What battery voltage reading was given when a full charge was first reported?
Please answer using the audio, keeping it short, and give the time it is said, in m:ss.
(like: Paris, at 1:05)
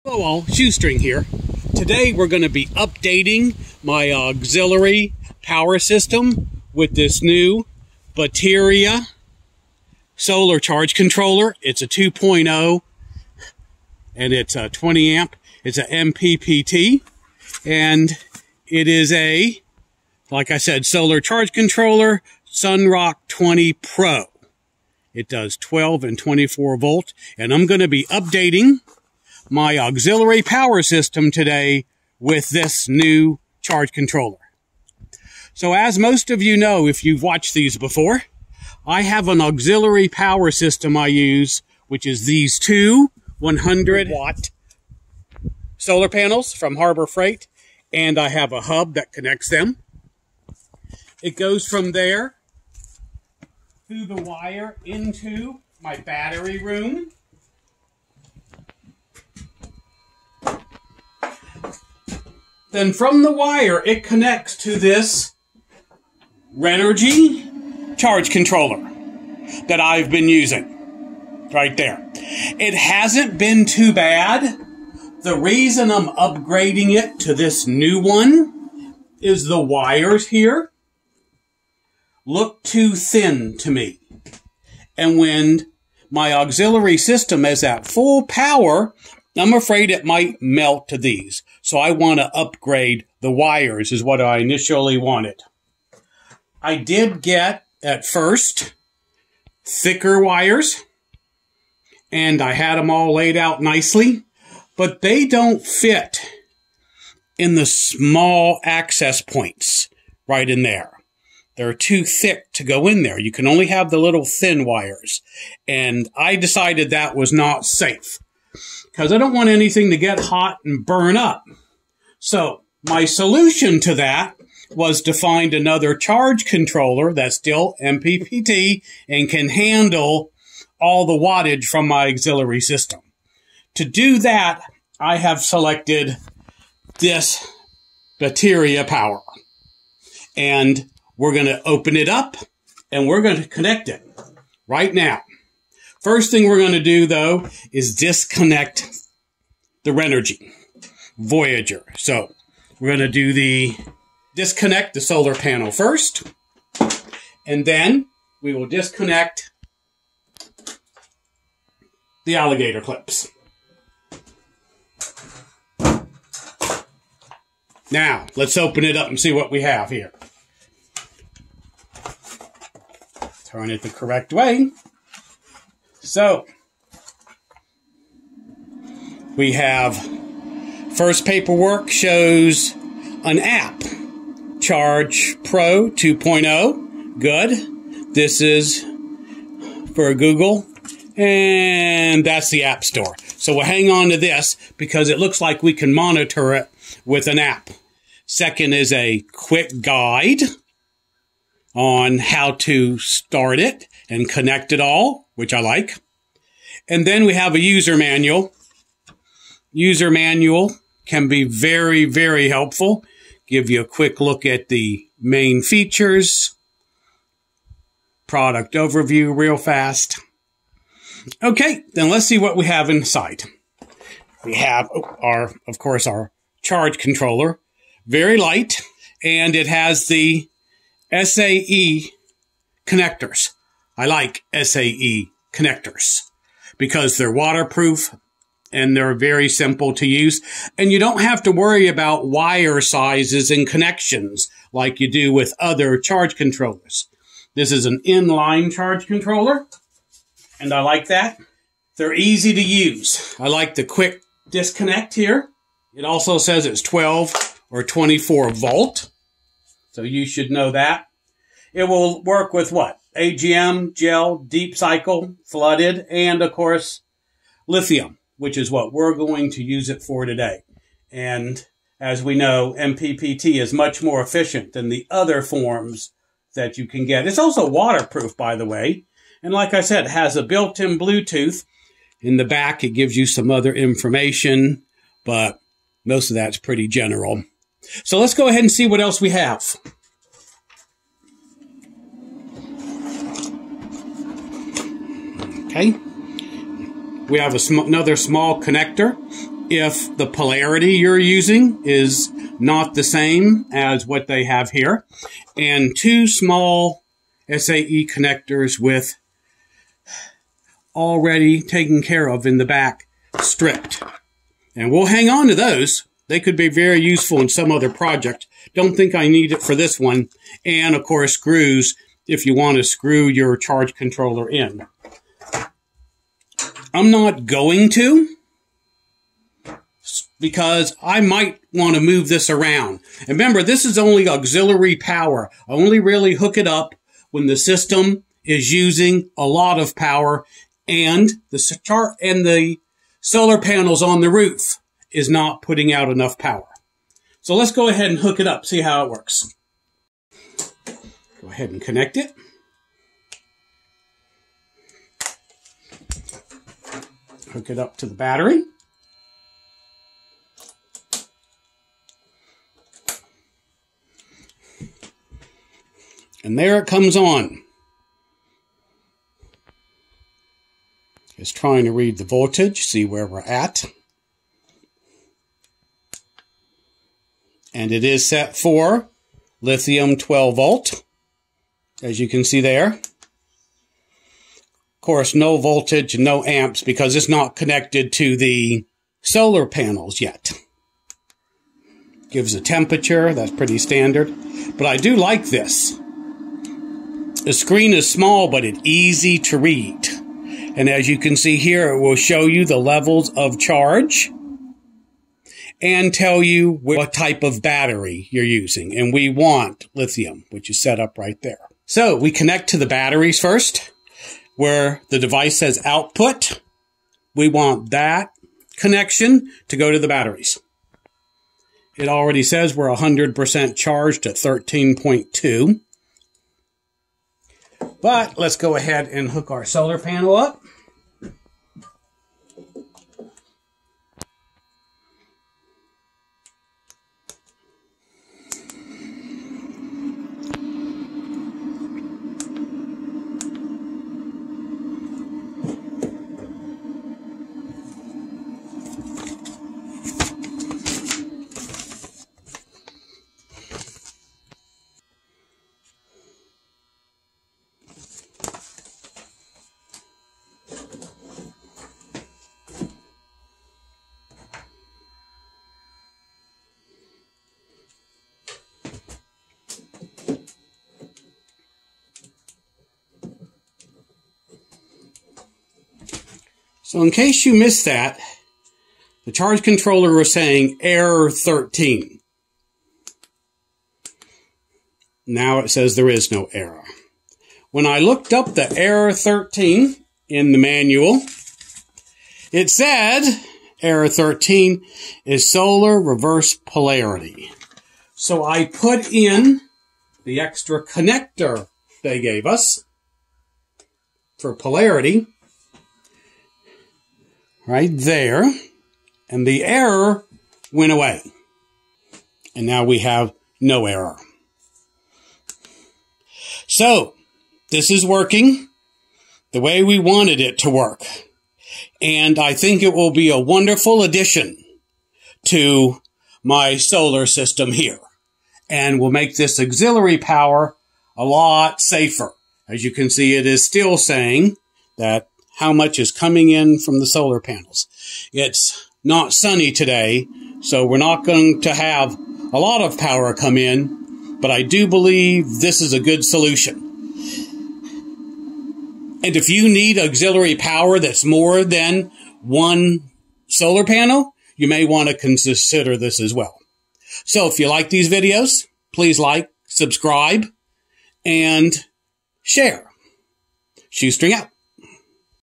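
13.2, at 7:04.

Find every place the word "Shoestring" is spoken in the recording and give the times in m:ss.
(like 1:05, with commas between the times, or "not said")
0:00, 9:23.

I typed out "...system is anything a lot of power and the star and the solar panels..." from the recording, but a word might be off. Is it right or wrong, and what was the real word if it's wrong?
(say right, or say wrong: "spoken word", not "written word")
wrong: "using", not "anything".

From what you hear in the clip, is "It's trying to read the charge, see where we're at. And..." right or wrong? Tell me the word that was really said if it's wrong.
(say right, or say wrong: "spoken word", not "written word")
wrong: "voltage", not "charge".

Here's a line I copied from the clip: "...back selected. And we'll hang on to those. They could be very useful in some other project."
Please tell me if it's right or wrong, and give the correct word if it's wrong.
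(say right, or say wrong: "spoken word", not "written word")
wrong: "stripped", not "selected".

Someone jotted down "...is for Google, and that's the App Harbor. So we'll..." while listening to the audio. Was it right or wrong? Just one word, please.
wrong.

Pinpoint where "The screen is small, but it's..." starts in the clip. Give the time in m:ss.
6:37.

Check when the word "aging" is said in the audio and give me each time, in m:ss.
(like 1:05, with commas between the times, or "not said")
not said.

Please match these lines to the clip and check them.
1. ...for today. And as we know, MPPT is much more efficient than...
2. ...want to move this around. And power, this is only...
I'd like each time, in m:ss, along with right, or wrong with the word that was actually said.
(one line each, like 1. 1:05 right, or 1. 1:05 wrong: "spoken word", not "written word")
1. 4:30 right
2. 5:31 wrong: "remember", not "power".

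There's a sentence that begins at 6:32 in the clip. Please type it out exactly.
Gives a temperature, that's pretty standard.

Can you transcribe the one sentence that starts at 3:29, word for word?
User manual can be very, very helpful.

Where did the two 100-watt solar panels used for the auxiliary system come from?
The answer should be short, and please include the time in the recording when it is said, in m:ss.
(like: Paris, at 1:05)
Harbor Freight, at 0:46.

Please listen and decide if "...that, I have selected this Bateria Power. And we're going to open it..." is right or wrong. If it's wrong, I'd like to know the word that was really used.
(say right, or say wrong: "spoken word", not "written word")
right.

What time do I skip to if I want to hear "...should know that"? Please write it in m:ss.
4:20.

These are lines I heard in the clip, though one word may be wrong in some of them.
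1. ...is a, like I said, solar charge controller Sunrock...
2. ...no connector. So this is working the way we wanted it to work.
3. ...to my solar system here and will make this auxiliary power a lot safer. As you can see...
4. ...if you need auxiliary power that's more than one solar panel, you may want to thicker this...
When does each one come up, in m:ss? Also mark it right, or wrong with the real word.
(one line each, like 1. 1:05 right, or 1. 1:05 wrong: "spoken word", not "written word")
1. 0:18 right
2. 8:33 wrong: "error", not "connector"
3. 8:45 right
4. 9:09 wrong: "consider", not "thicker".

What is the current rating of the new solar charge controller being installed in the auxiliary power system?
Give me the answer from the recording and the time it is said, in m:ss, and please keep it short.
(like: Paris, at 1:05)
20 amp, at 0:14.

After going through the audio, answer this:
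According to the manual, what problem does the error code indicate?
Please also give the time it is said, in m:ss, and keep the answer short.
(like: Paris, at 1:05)
solar reverse polarity, at 8:15.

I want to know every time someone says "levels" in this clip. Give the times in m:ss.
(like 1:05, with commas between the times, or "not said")
6:42.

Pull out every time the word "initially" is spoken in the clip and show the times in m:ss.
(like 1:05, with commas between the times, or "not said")
1:34.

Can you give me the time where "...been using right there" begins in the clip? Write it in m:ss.
1:10.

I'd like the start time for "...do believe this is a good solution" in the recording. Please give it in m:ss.
9:04.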